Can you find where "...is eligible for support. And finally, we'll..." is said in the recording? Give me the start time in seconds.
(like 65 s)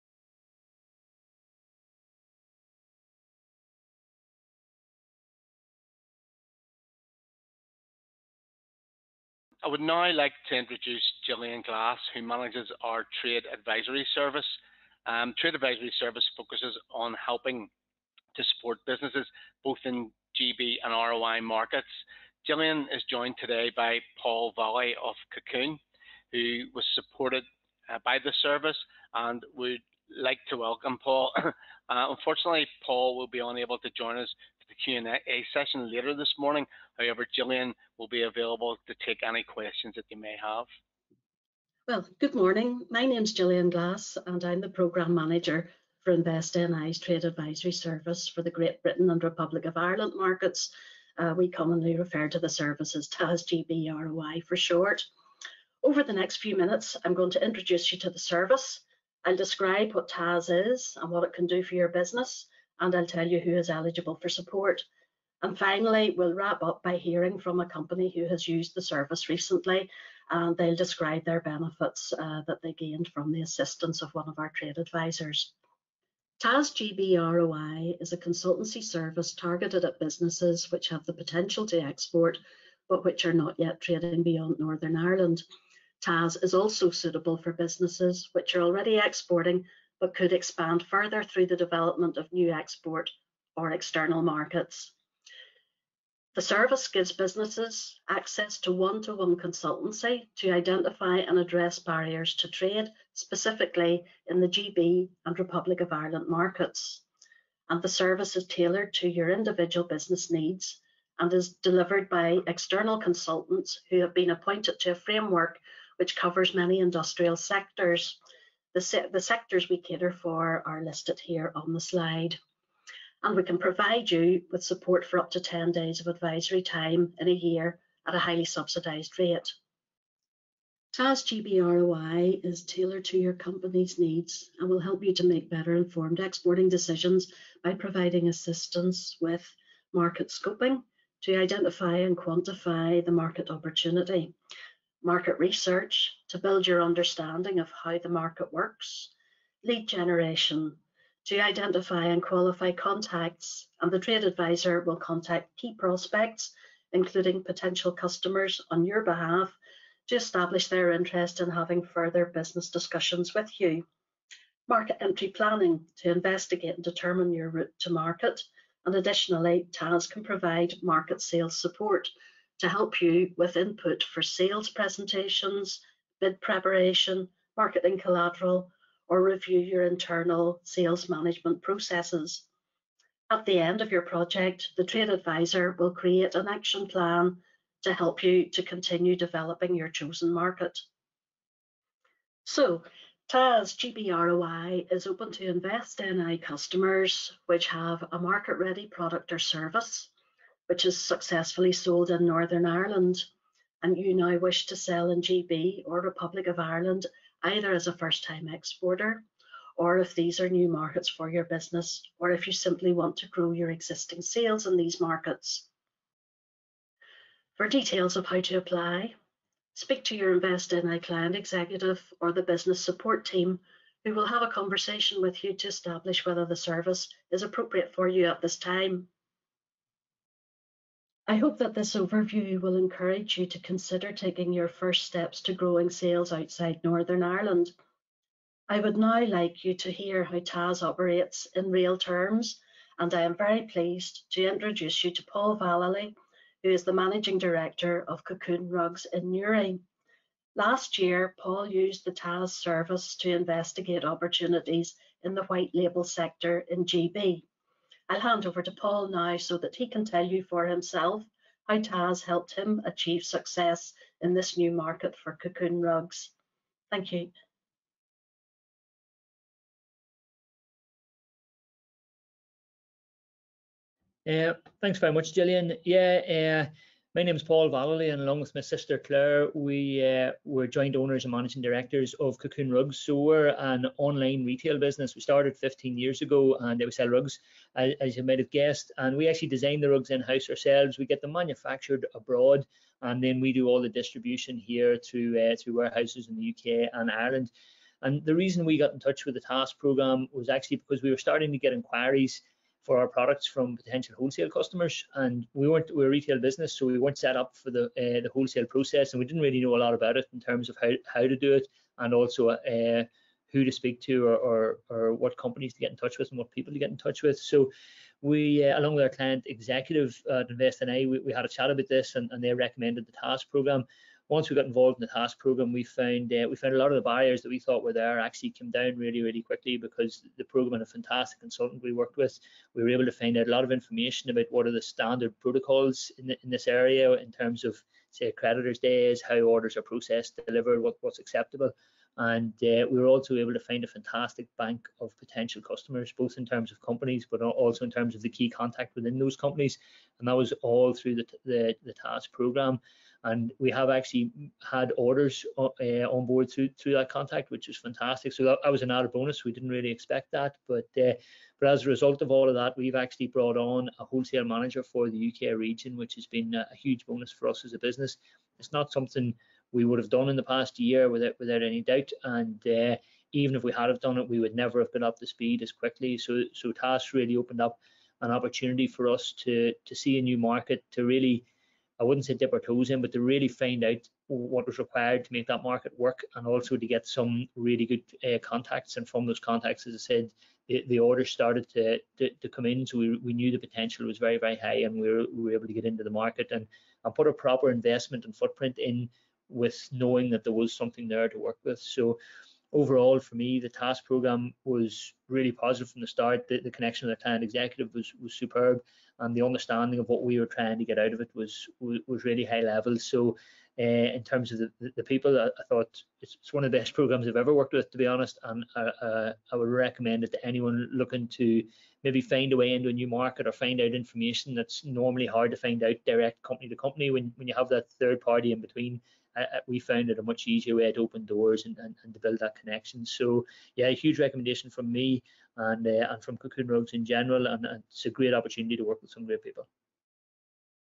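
63 s.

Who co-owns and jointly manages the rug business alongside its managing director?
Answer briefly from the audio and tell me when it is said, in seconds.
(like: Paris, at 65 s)
Claire, at 278 s.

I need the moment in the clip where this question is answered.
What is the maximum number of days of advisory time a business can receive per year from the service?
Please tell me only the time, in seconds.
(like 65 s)
125 s.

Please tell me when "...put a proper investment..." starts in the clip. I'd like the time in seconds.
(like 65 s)
397 s.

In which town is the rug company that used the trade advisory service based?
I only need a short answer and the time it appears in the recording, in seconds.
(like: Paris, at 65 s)
Newry, at 249 s.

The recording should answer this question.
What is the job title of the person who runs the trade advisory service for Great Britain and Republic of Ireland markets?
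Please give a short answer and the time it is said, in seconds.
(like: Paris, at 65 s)
Programme Manager, at 44 s.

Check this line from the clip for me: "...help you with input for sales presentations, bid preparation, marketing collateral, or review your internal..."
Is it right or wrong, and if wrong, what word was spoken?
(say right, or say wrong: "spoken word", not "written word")
right.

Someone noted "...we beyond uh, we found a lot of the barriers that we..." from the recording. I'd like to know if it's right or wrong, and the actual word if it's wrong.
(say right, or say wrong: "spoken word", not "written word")
wrong: "found", not "beyond".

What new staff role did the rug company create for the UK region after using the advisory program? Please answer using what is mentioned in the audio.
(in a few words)
Wholesale manager.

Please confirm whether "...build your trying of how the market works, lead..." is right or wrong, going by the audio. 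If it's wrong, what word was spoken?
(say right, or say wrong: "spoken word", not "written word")
wrong: "understanding", not "trying".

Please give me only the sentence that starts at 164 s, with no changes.
Market entry planning to investigate and determine your route to market.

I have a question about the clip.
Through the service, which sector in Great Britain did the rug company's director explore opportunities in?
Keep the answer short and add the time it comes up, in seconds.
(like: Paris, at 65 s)
White label, at 255 s.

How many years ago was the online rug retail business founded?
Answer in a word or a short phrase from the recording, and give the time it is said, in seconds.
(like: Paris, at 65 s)
15, at 285 s.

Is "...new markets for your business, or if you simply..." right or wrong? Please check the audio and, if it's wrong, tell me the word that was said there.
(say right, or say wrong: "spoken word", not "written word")
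right.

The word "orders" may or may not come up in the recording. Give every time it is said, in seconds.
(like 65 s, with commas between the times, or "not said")
339 s, 354 s, 390 s.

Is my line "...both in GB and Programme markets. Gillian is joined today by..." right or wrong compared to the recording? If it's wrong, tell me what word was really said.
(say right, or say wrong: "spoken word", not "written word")
wrong: "ROI", not "Programme".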